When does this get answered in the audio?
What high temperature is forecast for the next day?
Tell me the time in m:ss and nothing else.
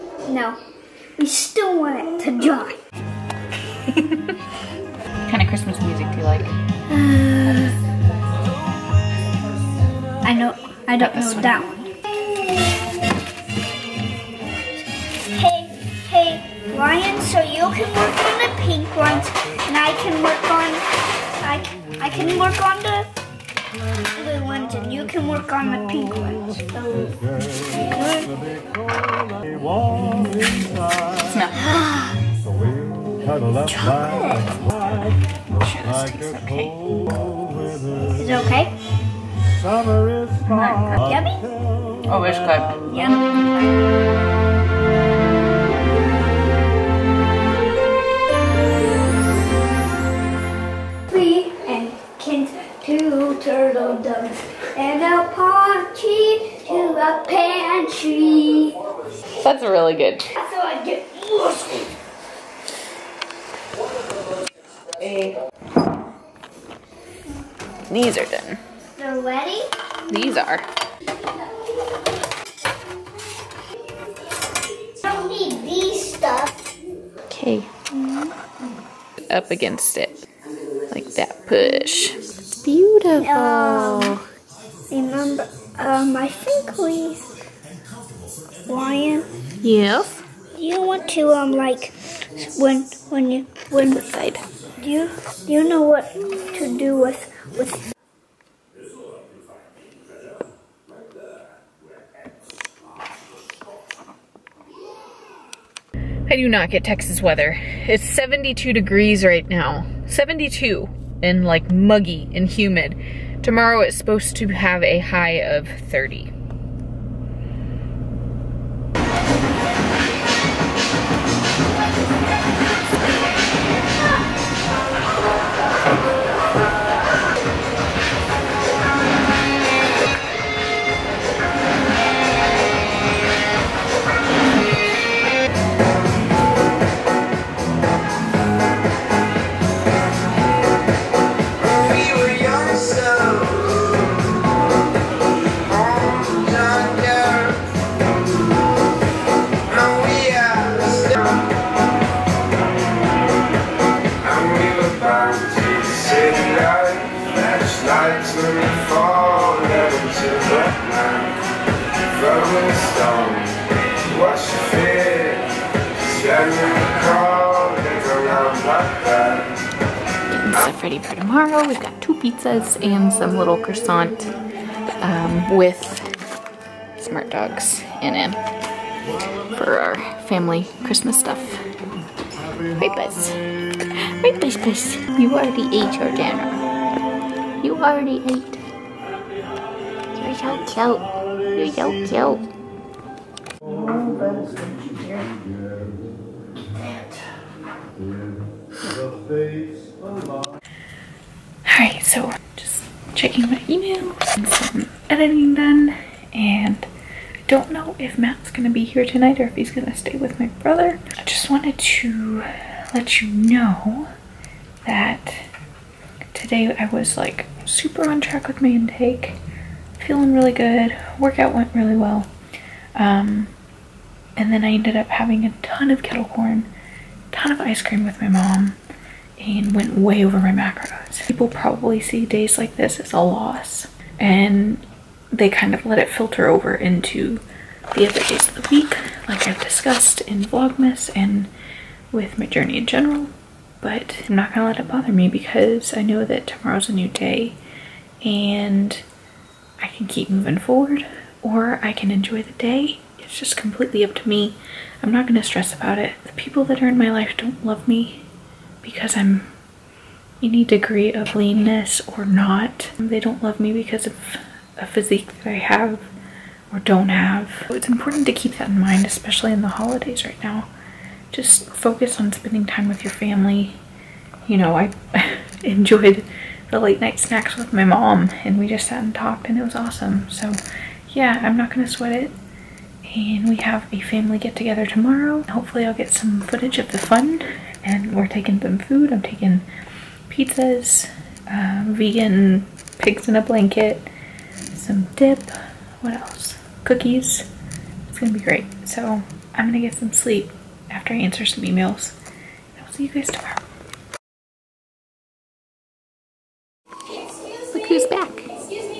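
1:54.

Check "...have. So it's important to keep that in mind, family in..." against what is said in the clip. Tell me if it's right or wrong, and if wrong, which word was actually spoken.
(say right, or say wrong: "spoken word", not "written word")
wrong: "especially", not "family".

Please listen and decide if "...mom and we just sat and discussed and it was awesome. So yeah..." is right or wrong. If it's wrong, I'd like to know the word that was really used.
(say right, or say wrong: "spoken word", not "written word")
wrong: "talked", not "discussed".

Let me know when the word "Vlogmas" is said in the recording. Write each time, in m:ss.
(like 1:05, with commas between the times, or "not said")
4:00.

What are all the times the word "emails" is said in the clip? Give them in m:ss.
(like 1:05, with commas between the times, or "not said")
3:23, 5:01.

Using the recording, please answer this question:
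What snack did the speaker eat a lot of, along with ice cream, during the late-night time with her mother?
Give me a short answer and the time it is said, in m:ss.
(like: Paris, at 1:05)
kettle corn, at 3:46.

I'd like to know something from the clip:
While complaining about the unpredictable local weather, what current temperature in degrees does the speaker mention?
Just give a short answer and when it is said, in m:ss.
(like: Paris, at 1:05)
72, at 1:47.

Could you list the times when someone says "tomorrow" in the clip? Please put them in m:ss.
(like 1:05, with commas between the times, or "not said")
1:53, 2:51, 4:06, 4:44, 5:03.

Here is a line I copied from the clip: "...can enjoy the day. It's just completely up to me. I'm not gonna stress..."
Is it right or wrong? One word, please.
right.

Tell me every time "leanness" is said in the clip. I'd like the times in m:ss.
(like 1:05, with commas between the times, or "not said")
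4:21.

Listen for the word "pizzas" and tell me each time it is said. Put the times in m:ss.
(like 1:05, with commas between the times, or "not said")
2:52, 4:50.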